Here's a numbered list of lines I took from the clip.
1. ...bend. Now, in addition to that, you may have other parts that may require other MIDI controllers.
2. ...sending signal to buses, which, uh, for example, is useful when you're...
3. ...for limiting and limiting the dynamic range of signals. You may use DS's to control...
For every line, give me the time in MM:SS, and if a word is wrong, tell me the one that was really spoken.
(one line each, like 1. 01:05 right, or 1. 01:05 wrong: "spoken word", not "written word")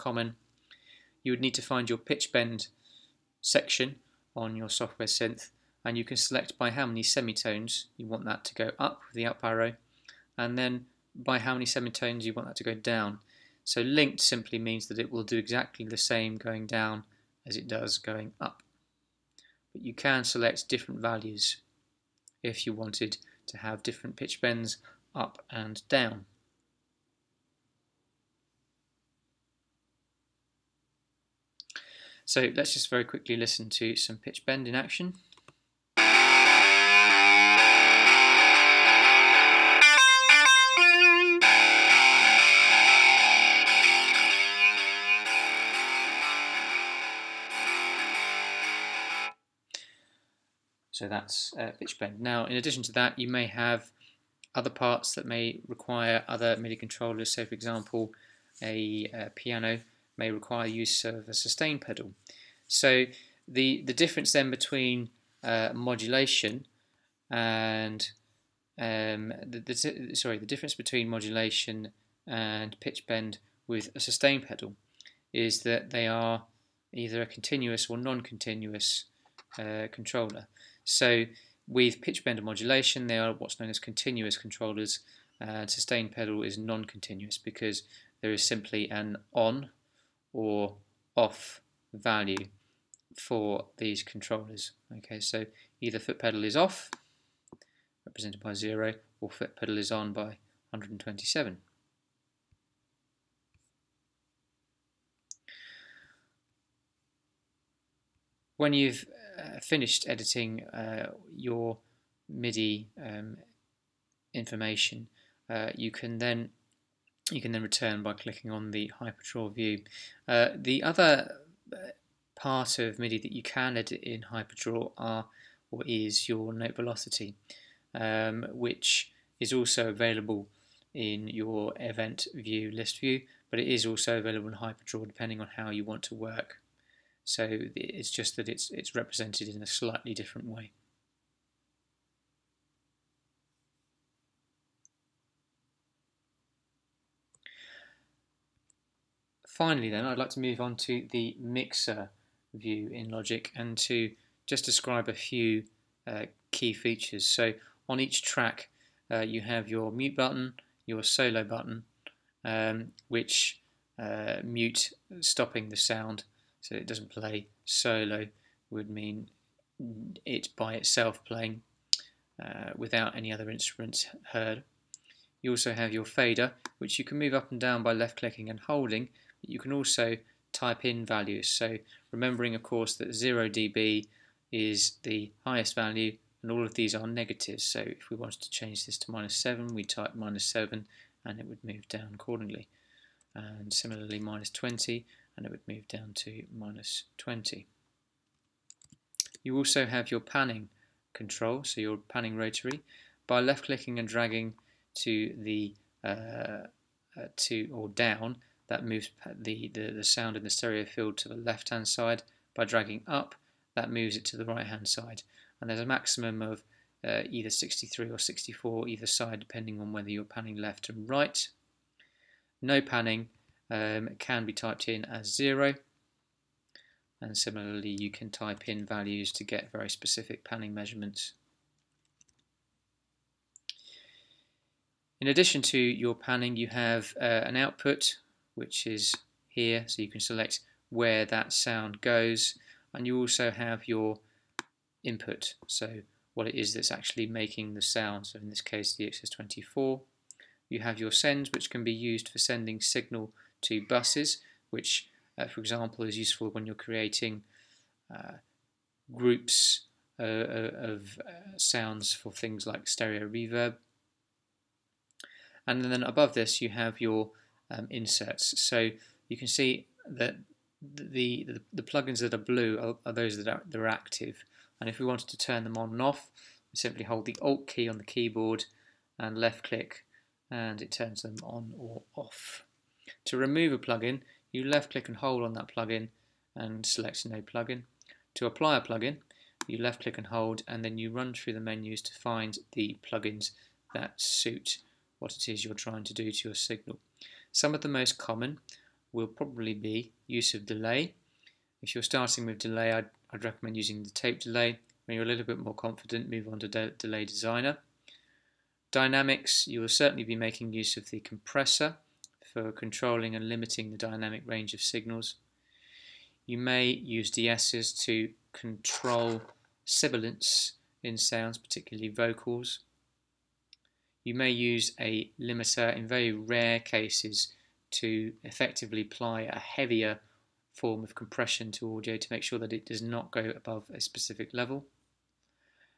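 1. 00:51 right
2. 04:12 right
3. 05:12 wrong: "controlling", not "limiting".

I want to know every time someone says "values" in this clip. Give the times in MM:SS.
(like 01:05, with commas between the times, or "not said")
00:20, 01:31, 03:01, 03:05, 03:48.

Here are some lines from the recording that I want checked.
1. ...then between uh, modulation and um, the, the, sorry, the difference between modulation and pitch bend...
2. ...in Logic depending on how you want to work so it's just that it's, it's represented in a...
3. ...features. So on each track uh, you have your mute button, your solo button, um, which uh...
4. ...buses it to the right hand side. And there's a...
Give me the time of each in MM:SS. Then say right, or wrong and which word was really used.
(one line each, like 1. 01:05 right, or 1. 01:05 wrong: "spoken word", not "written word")
1. 01:04 right
2. 02:14 wrong: "HyperDraw", not "Logic"
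3. 02:36 right
4. 03:33 wrong: "moves", not "buses".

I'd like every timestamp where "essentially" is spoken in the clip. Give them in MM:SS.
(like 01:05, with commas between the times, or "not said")
not said.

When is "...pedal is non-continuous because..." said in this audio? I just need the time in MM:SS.
01:26.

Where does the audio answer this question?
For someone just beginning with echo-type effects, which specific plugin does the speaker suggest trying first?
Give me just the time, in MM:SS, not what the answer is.
05:04.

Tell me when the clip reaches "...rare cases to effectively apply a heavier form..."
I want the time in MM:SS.
05:26.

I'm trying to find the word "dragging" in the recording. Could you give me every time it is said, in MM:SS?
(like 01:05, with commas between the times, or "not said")
03:24, 03:32.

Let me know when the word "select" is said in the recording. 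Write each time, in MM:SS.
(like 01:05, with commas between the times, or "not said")
00:06, 00:20, 04:00, 04:46.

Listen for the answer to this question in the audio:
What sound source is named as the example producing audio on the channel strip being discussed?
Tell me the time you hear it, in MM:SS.
04:09.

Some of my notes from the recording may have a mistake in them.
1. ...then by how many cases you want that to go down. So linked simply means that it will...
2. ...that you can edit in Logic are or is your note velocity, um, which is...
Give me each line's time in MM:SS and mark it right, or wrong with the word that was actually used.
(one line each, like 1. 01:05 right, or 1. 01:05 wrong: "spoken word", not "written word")
1. 00:10 wrong: "semitones", not "cases"
2. 02:03 wrong: "HyperDraw", not "Logic".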